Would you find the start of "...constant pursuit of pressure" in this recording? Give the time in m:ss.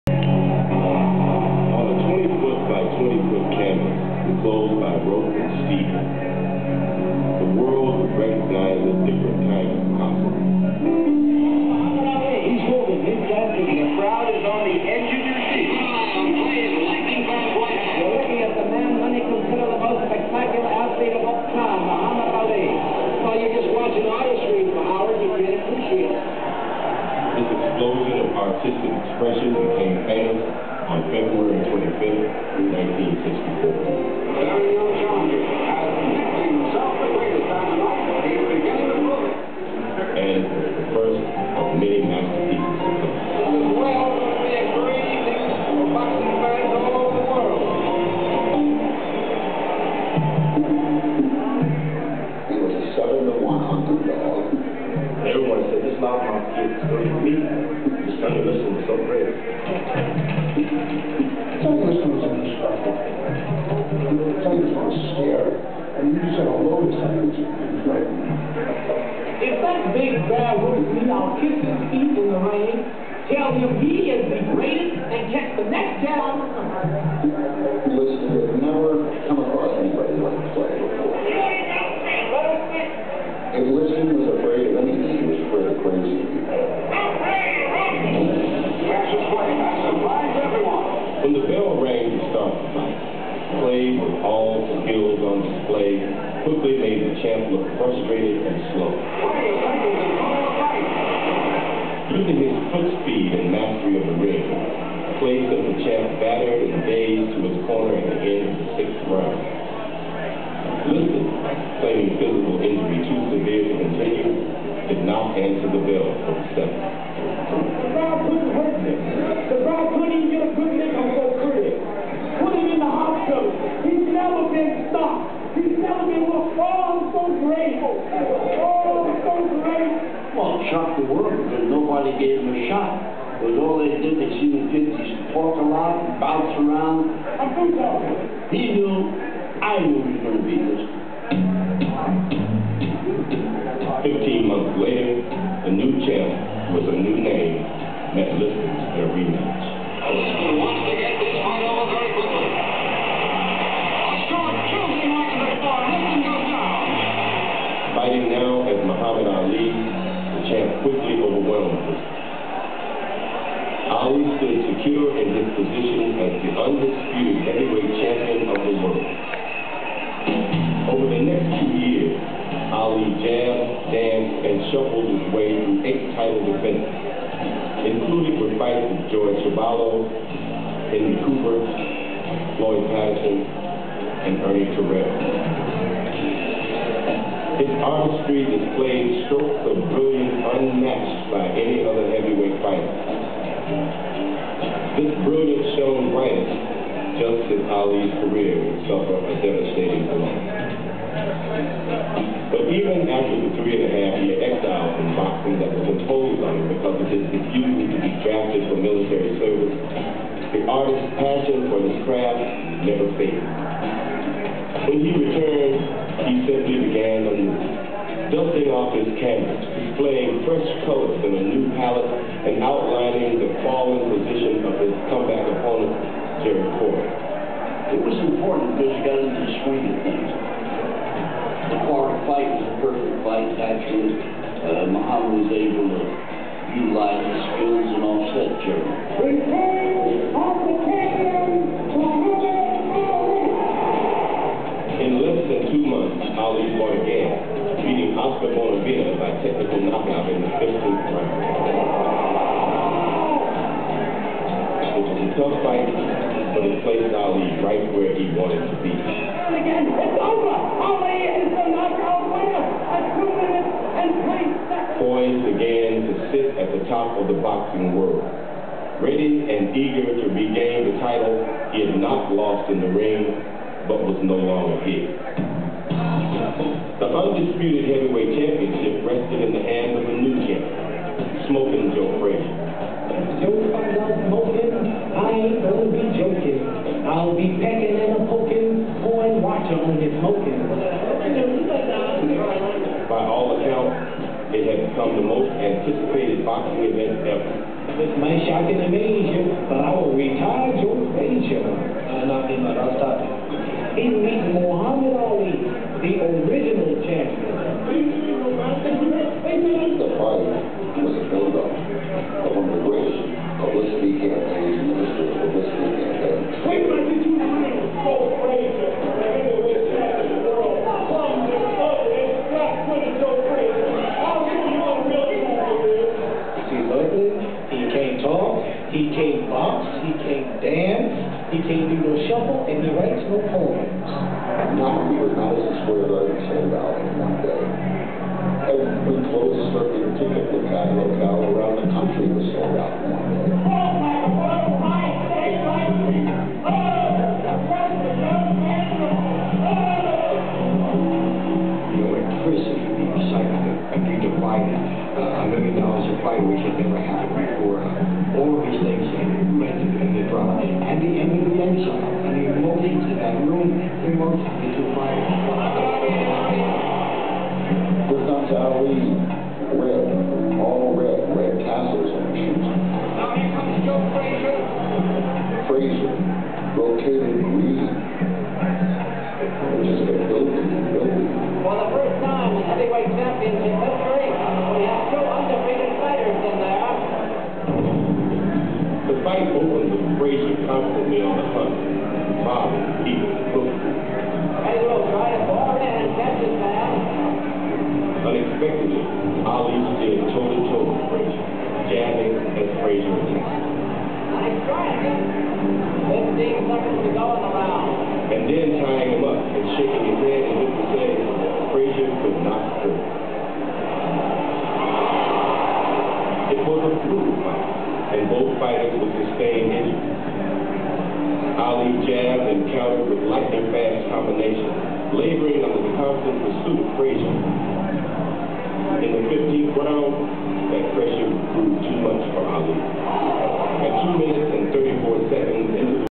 7:05.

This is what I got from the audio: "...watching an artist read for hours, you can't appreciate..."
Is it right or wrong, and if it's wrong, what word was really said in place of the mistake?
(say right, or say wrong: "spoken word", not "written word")
right.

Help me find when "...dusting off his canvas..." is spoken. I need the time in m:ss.
3:38.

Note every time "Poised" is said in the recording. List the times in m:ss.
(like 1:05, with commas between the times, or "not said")
4:25.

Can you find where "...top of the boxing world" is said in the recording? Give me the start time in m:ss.
4:26.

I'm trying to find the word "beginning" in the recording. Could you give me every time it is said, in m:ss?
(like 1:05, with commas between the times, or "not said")
not said.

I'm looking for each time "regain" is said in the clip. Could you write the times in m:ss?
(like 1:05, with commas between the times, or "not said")
4:30.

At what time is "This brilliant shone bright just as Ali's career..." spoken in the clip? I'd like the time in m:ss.
3:14.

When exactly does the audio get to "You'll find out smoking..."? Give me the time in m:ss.
4:43.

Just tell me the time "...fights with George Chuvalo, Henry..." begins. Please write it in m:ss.
2:58.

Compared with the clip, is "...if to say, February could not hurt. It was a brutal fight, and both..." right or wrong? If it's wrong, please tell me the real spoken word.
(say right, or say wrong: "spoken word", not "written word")
wrong: "Frazier", not "February".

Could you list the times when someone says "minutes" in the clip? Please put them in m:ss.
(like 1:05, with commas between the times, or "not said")
4:23, 7:14.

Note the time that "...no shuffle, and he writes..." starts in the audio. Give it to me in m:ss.
5:32.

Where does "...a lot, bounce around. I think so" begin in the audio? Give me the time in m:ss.
2:15.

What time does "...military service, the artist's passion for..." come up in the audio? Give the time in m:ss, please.
3:28.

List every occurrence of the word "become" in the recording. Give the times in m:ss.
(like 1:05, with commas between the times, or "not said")
4:54.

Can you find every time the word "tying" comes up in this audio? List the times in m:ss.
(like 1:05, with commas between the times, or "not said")
6:48.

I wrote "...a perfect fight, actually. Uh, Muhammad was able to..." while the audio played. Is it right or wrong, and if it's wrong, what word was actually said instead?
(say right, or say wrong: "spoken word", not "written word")
right.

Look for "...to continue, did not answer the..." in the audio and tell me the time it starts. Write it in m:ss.
1:53.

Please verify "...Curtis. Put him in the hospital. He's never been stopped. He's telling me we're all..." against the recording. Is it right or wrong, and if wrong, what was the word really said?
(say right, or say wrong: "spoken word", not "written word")
right.